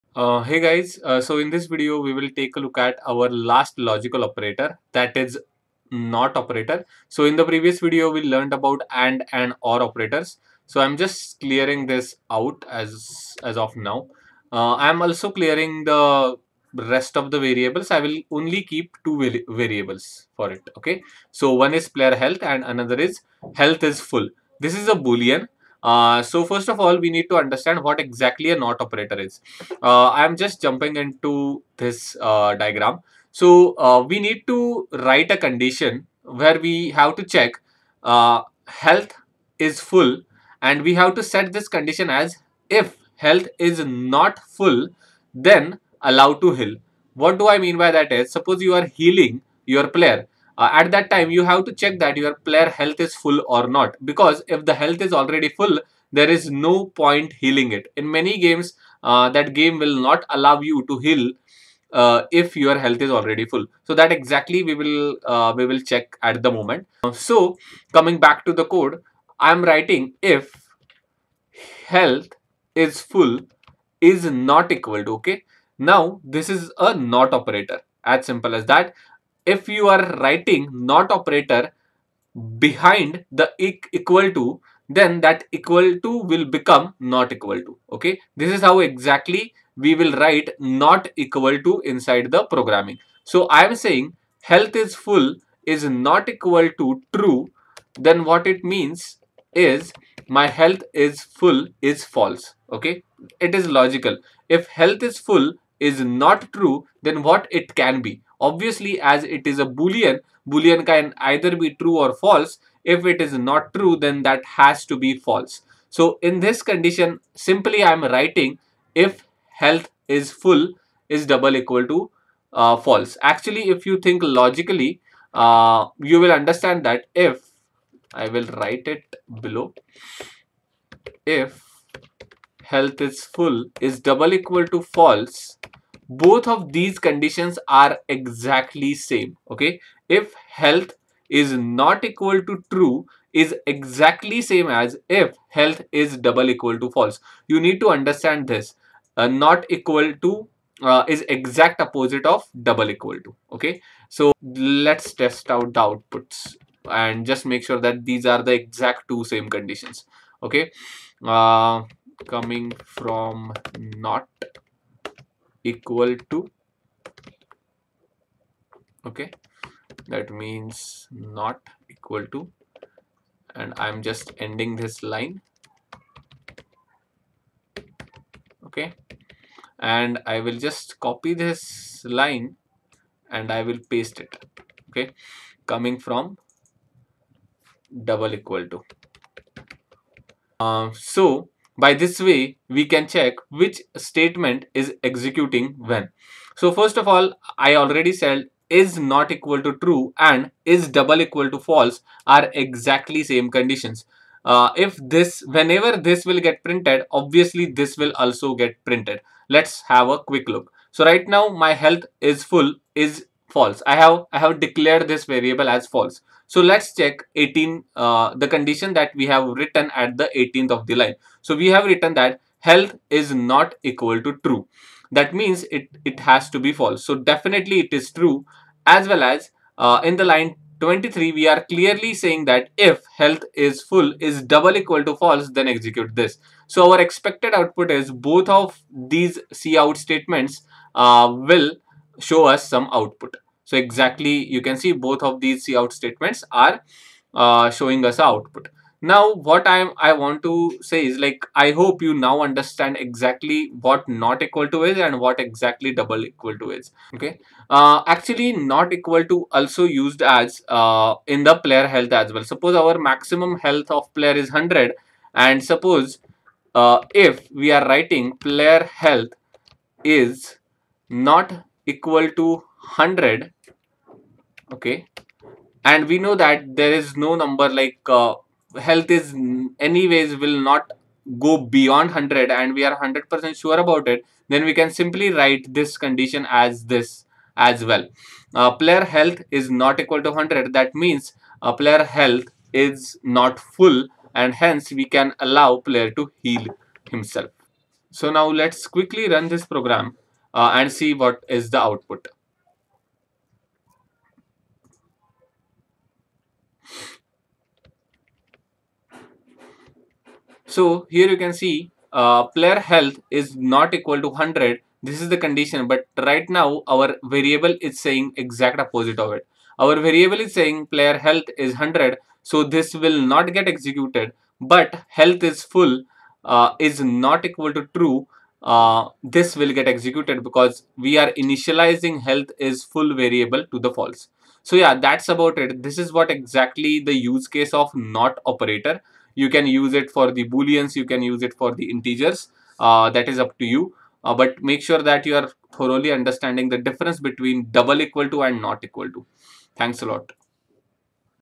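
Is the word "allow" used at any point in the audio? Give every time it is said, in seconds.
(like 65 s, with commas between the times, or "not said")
46 s, 60 s, 295 s.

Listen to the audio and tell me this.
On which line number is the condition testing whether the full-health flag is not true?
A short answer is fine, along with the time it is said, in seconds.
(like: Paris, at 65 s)
18, at 217 s.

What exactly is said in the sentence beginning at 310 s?
So here you can see uh, player health is not equal to 100.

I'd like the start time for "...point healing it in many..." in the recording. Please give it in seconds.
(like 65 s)
57 s.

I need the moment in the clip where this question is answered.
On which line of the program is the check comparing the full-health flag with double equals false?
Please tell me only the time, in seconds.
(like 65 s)
230 s.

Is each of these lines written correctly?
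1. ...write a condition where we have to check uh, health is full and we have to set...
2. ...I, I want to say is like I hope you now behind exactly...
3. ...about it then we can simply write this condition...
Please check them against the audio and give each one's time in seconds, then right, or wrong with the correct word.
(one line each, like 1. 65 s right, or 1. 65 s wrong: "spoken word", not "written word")
1. 34 s right
2. 249 s wrong: "understand", not "behind"
3. 283 s right.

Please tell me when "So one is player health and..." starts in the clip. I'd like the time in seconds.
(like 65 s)
21 s.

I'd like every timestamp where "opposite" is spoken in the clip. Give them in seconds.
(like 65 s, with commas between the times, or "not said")
151 s, 318 s.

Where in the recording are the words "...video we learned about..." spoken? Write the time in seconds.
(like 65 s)
7 s.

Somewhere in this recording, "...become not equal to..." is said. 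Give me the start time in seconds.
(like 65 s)
86 s.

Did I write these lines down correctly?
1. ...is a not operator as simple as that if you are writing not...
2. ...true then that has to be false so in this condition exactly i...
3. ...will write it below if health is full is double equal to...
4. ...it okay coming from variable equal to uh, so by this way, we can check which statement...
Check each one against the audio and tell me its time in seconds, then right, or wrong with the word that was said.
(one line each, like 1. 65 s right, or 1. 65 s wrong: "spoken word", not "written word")
1. 76 s right
2. 113 s wrong: "simply", not "exactly"
3. 128 s right
4. 184 s wrong: "double", not "variable".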